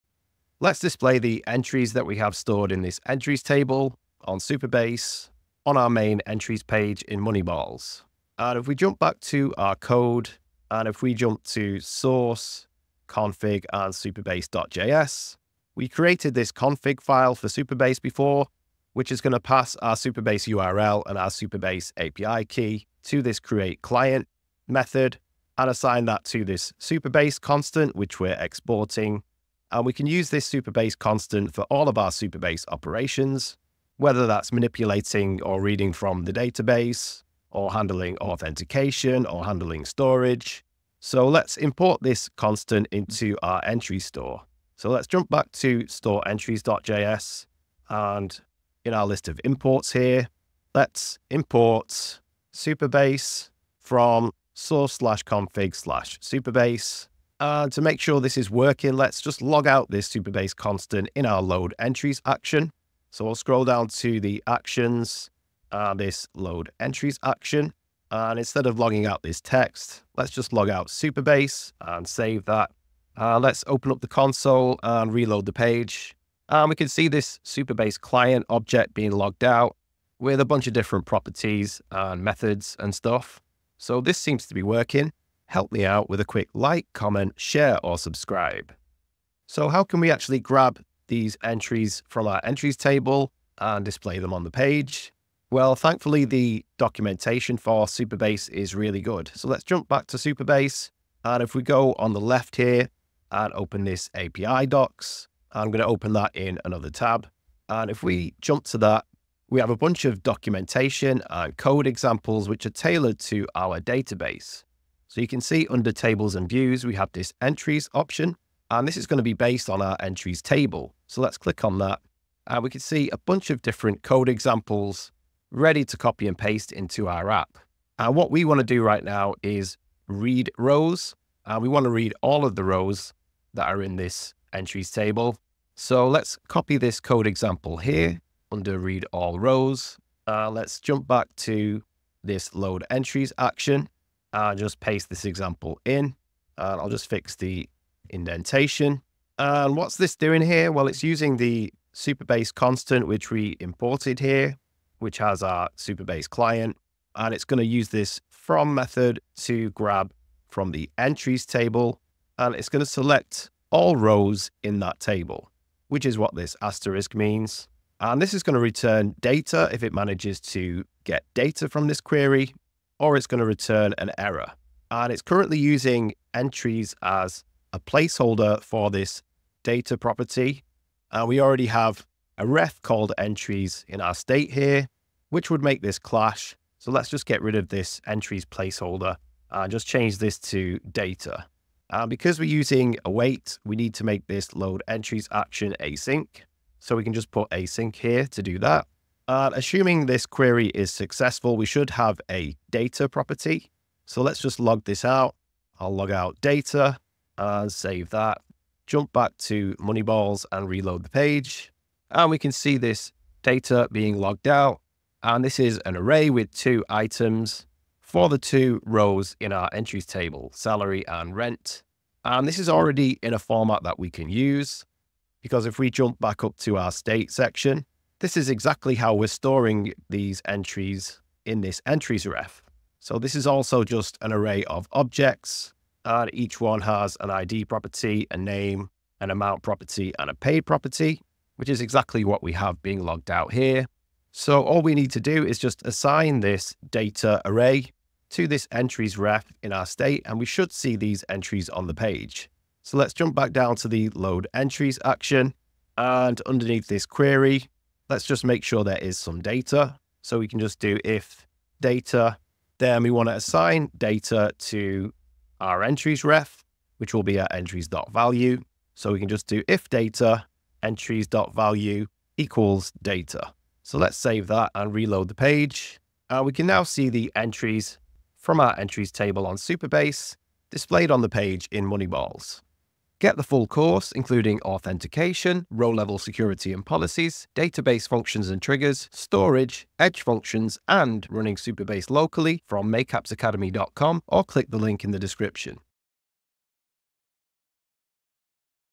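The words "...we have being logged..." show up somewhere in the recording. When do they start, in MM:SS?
04:02.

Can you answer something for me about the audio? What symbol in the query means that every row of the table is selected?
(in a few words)
asterisk.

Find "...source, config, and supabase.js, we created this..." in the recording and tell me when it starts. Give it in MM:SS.
00:11.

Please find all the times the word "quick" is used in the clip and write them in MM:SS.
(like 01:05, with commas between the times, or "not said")
01:26.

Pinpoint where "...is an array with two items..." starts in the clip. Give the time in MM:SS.
03:35.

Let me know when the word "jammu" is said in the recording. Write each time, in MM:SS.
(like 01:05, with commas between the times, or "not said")
not said.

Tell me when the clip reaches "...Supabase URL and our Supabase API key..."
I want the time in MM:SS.
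00:19.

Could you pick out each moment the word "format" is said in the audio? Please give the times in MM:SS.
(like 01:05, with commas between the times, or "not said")
03:43.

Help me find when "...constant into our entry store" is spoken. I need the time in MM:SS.
00:42.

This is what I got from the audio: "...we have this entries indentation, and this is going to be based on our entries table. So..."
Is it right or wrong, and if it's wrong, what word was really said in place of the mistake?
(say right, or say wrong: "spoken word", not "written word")
wrong: "option", not "indentation".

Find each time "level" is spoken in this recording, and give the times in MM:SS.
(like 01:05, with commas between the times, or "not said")
04:45.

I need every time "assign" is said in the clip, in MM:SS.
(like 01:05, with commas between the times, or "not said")
00:25, 04:05, 04:23.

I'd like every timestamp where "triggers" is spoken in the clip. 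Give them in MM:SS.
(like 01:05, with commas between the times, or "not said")
04:48.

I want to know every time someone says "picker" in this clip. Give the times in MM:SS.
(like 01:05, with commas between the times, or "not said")
not said.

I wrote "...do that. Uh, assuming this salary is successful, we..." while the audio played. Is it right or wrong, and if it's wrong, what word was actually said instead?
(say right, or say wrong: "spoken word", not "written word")
wrong: "query", not "salary".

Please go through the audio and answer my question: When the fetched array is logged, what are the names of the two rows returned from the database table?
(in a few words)
salary and rent.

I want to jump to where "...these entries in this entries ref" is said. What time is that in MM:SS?
03:50.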